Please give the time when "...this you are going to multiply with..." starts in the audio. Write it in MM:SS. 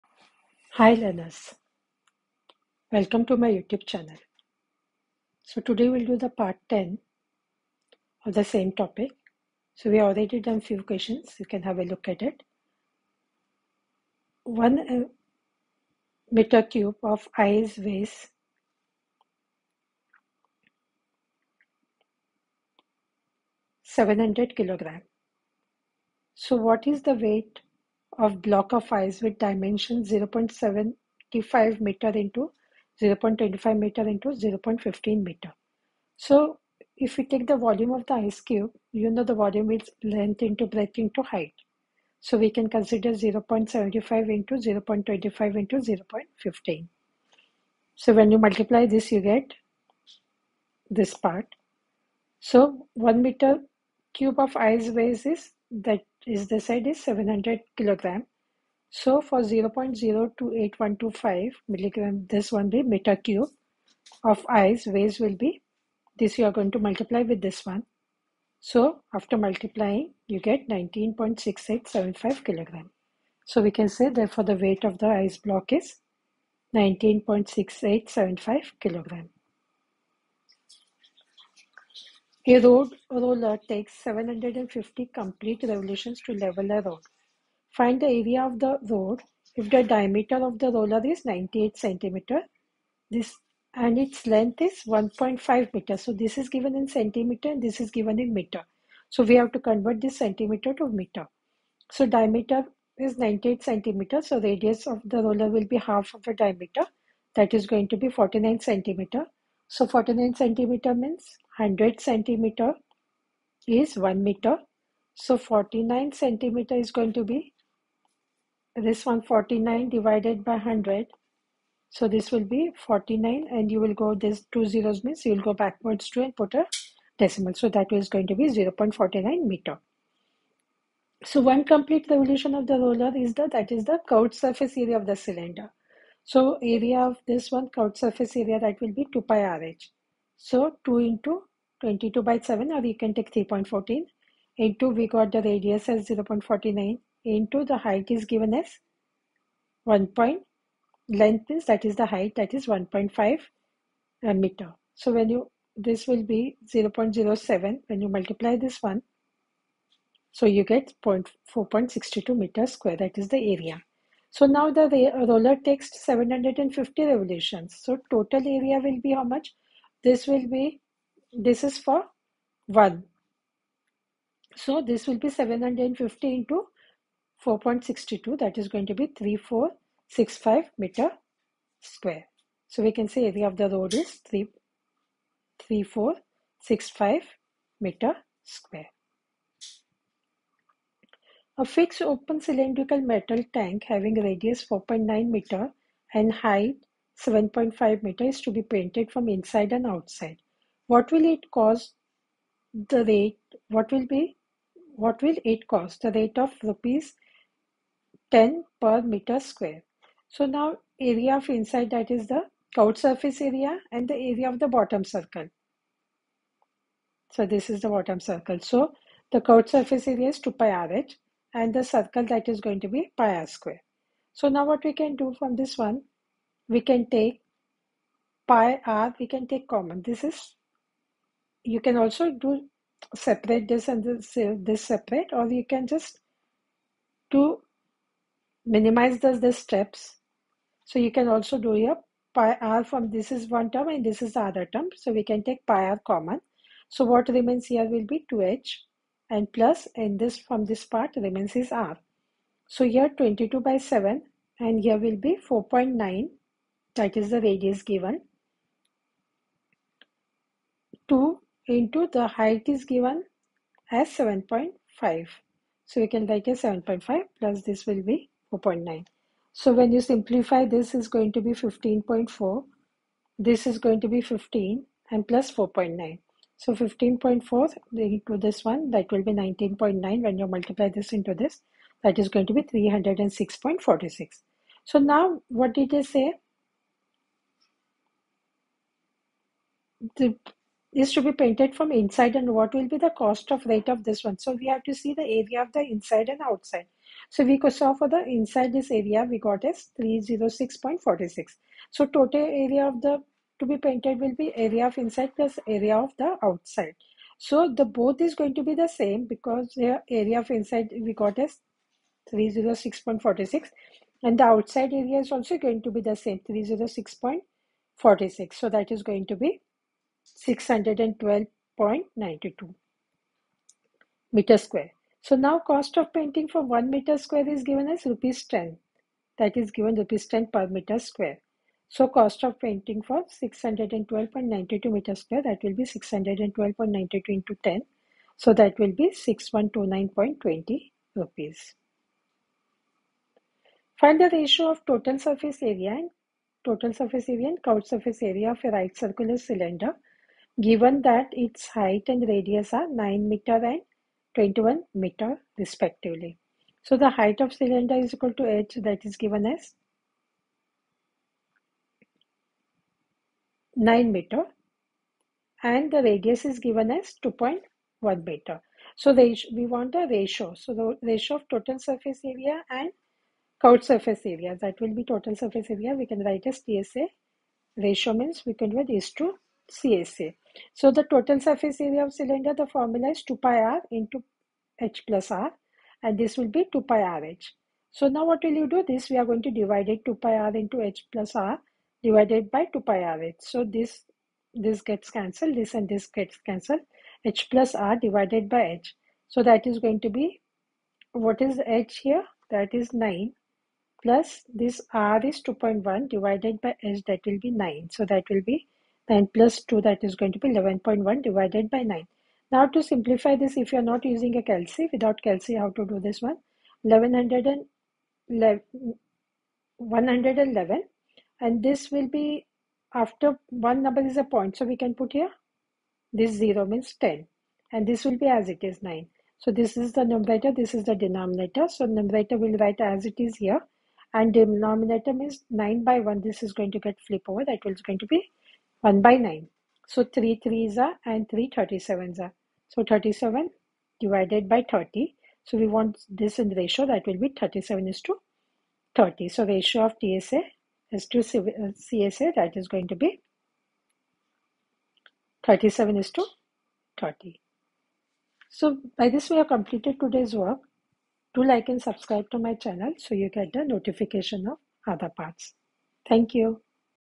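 01:06.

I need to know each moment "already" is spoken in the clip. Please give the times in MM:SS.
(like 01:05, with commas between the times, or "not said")
00:09.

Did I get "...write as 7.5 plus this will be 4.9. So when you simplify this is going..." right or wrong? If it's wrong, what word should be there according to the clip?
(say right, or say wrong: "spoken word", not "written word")
right.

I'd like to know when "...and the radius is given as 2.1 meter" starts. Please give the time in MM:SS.
06:05.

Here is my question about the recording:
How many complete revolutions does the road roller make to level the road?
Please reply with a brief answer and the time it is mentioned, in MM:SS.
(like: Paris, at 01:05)
750, at 01:24.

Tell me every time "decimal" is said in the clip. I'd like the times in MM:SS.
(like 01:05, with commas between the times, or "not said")
02:07.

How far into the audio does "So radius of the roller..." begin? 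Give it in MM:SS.
01:44.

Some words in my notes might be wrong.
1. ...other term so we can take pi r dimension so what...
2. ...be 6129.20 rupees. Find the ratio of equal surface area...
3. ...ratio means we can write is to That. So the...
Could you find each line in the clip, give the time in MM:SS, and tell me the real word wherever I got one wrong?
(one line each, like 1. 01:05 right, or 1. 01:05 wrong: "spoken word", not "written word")
1. 04:04 wrong: "common", not "dimension"
2. 05:38 wrong: "total", not "equal"
3. 06:17 wrong: "CSA", not "That".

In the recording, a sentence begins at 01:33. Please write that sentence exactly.
This and its length is 1.5 meter.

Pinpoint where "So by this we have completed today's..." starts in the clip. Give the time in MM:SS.
07:38.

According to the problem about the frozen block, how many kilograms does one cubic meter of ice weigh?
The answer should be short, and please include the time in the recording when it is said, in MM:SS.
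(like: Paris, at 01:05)
700 kilograms, at 00:57.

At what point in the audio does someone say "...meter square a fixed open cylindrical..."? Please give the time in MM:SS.
03:07.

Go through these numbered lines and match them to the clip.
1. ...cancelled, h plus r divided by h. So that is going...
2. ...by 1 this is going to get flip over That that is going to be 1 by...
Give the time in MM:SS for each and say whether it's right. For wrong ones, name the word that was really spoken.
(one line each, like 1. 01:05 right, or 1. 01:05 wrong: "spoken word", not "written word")
1. 06:36 right
2. 07:15 right.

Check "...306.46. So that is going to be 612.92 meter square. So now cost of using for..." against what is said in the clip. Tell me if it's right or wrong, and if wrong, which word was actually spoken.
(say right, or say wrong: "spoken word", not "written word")
wrong: "painting", not "using".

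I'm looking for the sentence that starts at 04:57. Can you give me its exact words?
So we saw for the inside this area we got as 306.46.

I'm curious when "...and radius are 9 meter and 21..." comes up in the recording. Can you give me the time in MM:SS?
05:52.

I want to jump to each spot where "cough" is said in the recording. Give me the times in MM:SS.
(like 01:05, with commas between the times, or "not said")
not said.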